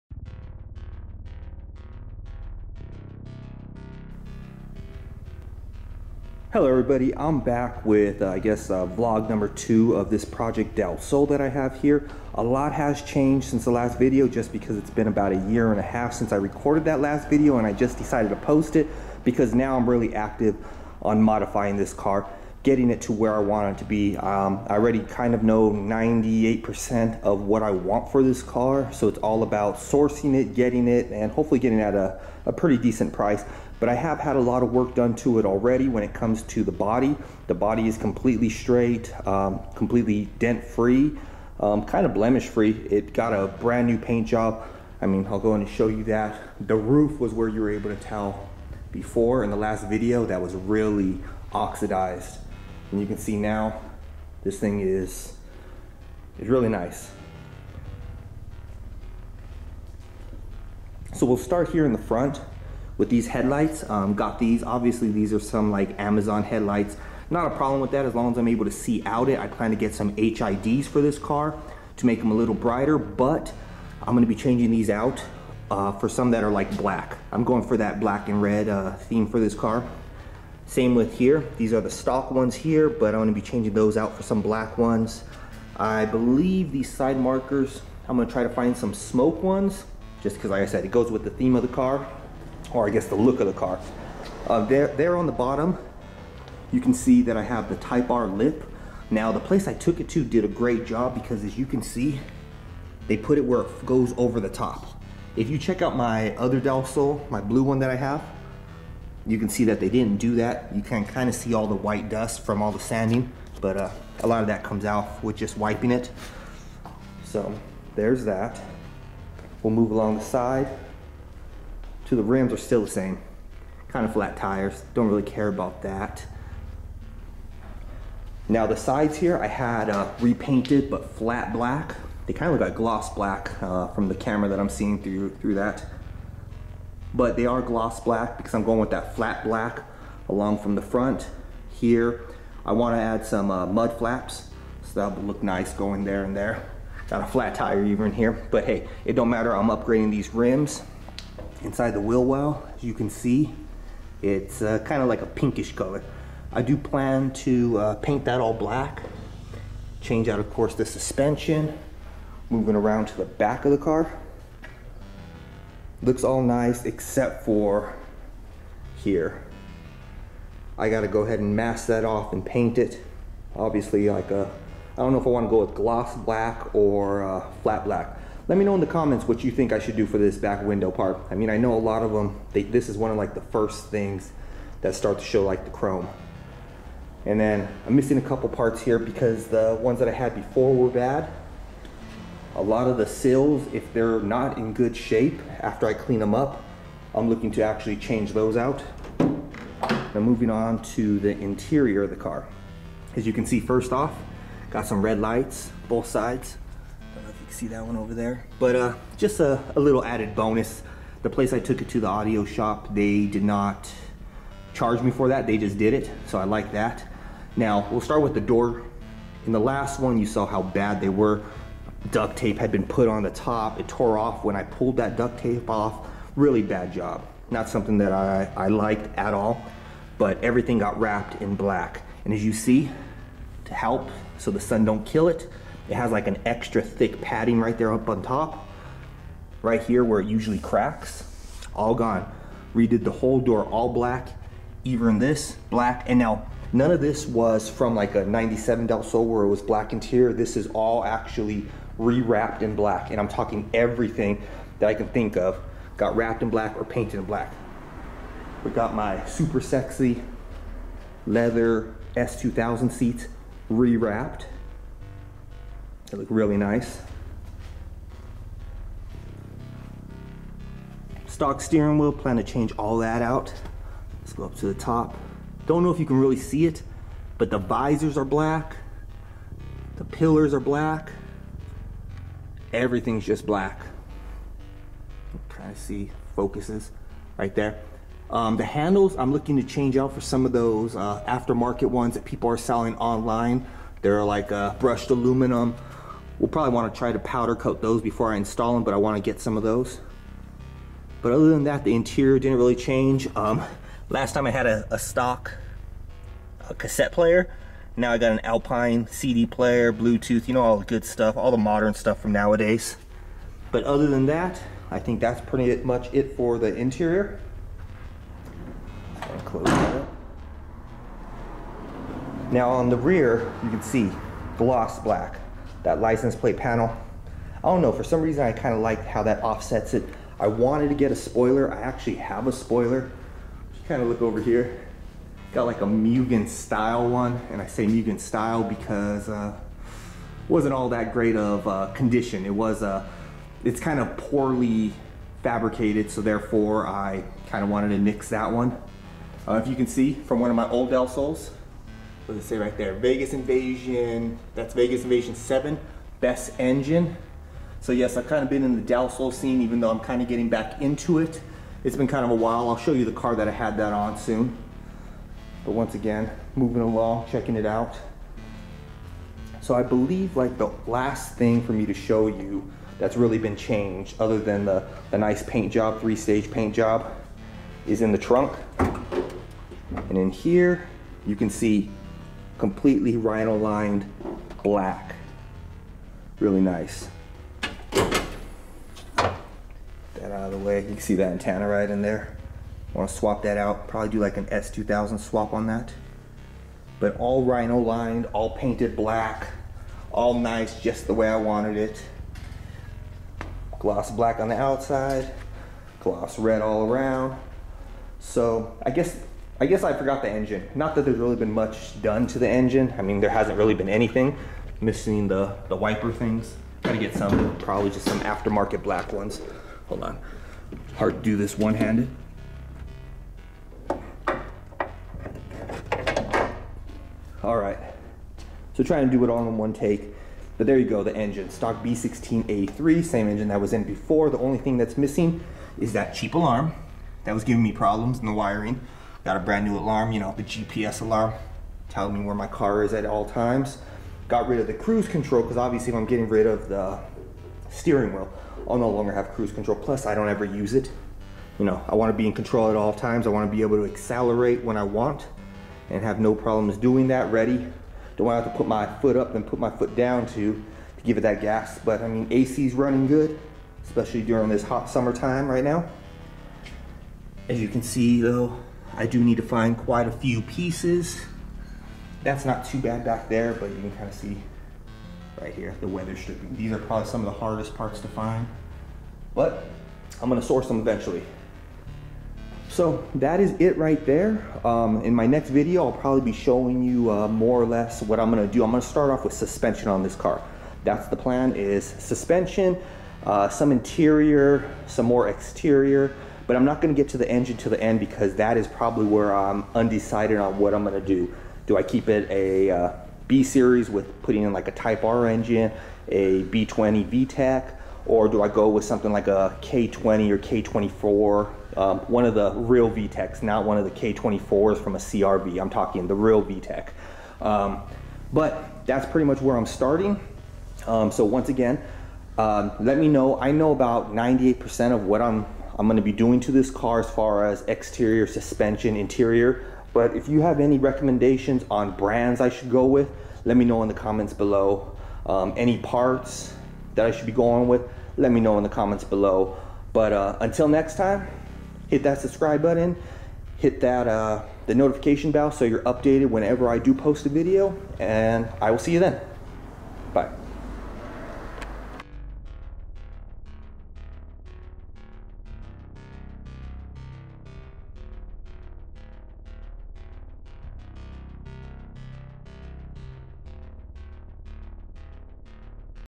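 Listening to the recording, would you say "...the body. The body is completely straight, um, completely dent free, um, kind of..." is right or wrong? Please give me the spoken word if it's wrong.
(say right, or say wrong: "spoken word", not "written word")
right.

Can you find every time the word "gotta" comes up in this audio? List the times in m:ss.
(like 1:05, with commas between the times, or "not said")
2:50, 6:56.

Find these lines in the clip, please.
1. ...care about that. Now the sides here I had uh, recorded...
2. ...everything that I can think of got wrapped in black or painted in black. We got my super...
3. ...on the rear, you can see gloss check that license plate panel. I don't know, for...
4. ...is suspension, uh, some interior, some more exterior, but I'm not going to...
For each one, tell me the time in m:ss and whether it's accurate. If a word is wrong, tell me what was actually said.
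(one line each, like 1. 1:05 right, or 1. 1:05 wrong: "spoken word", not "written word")
1. 2:05 wrong: "repainted", not "recorded"
2. 4:13 right
3. 5:22 wrong: "black", not "check"
4. 8:11 right.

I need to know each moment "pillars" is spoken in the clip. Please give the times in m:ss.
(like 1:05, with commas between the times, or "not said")
4:40.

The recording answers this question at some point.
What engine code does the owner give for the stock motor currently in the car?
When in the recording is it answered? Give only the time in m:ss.
7:11.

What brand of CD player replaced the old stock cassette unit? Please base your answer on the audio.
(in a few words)
Alpine.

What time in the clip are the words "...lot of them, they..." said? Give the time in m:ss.
3:01.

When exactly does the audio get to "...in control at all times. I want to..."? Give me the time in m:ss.
7:32.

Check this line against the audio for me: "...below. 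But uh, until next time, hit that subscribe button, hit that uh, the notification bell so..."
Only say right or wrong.
right.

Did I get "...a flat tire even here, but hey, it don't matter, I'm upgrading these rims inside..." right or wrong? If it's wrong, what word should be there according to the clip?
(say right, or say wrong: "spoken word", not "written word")
right.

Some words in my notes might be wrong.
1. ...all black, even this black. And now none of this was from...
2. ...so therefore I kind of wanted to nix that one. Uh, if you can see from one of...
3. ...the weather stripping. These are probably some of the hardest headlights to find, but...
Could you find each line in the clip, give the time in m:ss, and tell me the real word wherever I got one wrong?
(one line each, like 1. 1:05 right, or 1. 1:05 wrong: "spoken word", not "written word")
1. 4:03 right
2. 5:46 right
3. 7:55 wrong: "parts", not "headlights".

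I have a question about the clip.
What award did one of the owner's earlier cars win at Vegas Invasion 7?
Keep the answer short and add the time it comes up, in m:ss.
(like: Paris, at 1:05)
best engine, at 5:56.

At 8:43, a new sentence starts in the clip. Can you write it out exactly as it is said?
I know about 98% of what I'm I'm going to be doing to this car as far as exterior, suspension, interior.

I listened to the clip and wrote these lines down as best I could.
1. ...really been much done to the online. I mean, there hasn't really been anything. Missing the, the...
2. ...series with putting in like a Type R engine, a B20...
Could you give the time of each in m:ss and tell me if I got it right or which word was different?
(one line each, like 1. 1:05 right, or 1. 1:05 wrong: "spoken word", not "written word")
1. 6:51 wrong: "engine", not "online"
2. 8:23 right.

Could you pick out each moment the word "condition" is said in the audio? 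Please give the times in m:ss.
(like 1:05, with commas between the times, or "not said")
5:41.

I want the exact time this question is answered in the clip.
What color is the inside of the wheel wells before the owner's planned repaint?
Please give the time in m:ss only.
2:35.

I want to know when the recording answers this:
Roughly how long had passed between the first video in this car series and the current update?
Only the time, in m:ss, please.
0:15.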